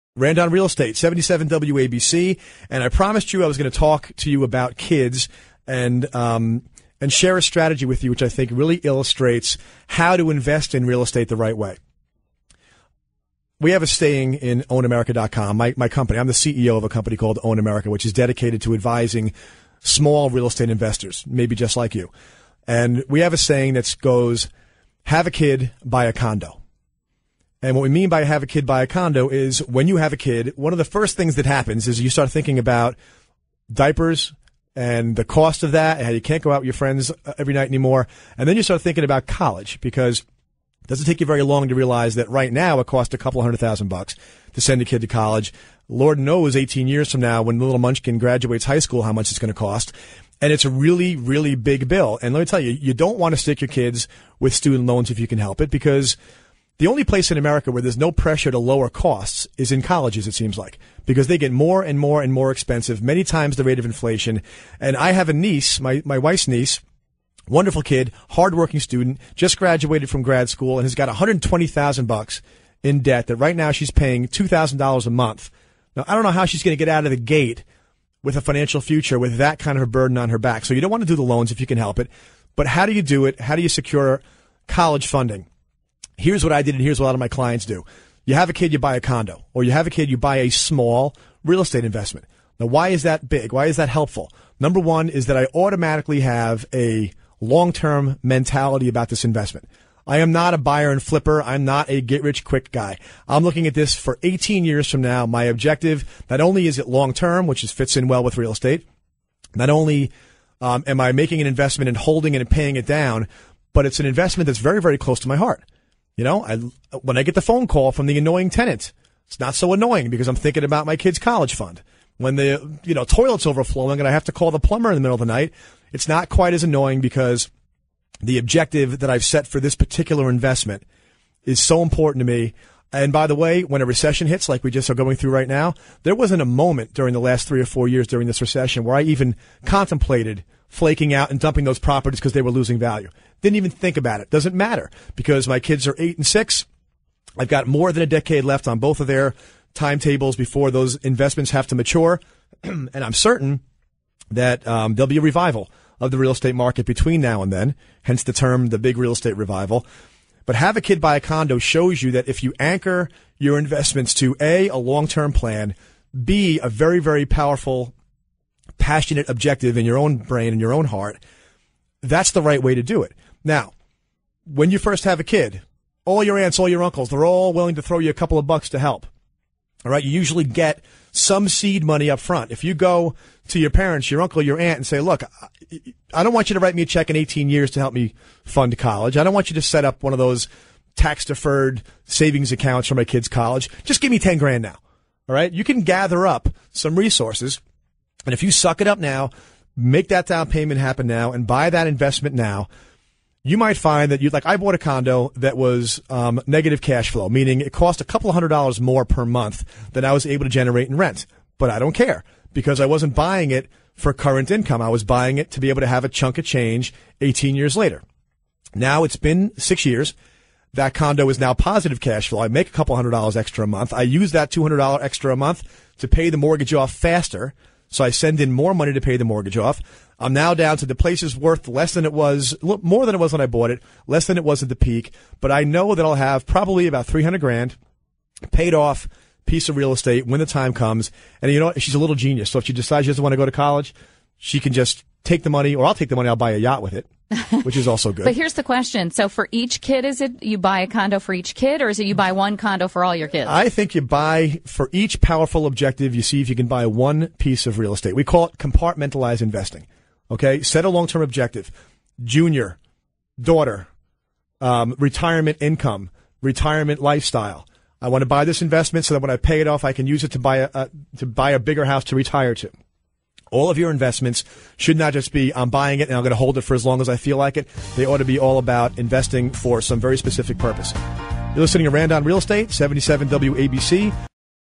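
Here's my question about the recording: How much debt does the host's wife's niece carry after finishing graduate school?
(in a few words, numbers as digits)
$120,000.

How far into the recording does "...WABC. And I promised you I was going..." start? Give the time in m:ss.
0:01.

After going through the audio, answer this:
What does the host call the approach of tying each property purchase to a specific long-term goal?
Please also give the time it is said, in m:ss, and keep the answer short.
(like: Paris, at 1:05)
compartmentalized investing, at 4:18.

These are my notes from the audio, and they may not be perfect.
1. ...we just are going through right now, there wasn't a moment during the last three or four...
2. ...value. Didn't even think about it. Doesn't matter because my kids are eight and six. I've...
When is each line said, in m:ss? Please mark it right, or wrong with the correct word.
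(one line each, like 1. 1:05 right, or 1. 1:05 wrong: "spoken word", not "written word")
1. 2:14 right
2. 2:22 right.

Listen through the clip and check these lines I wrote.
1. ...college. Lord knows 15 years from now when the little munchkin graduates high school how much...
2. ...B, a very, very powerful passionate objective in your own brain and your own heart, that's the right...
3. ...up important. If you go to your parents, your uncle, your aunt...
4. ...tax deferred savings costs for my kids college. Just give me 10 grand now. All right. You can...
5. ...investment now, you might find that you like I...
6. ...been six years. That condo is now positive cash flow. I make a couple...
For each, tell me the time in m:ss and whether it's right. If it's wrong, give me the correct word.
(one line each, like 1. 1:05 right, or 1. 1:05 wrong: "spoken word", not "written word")
1. 0:45 wrong: "18", not "15"
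2. 2:46 right
3. 3:02 wrong: "front", not "important"
4. 3:10 wrong: "accounts", not "costs"
5. 3:21 right
6. 3:39 right.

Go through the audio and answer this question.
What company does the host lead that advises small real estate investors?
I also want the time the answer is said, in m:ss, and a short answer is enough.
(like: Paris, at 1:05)
Own America, at 0:17.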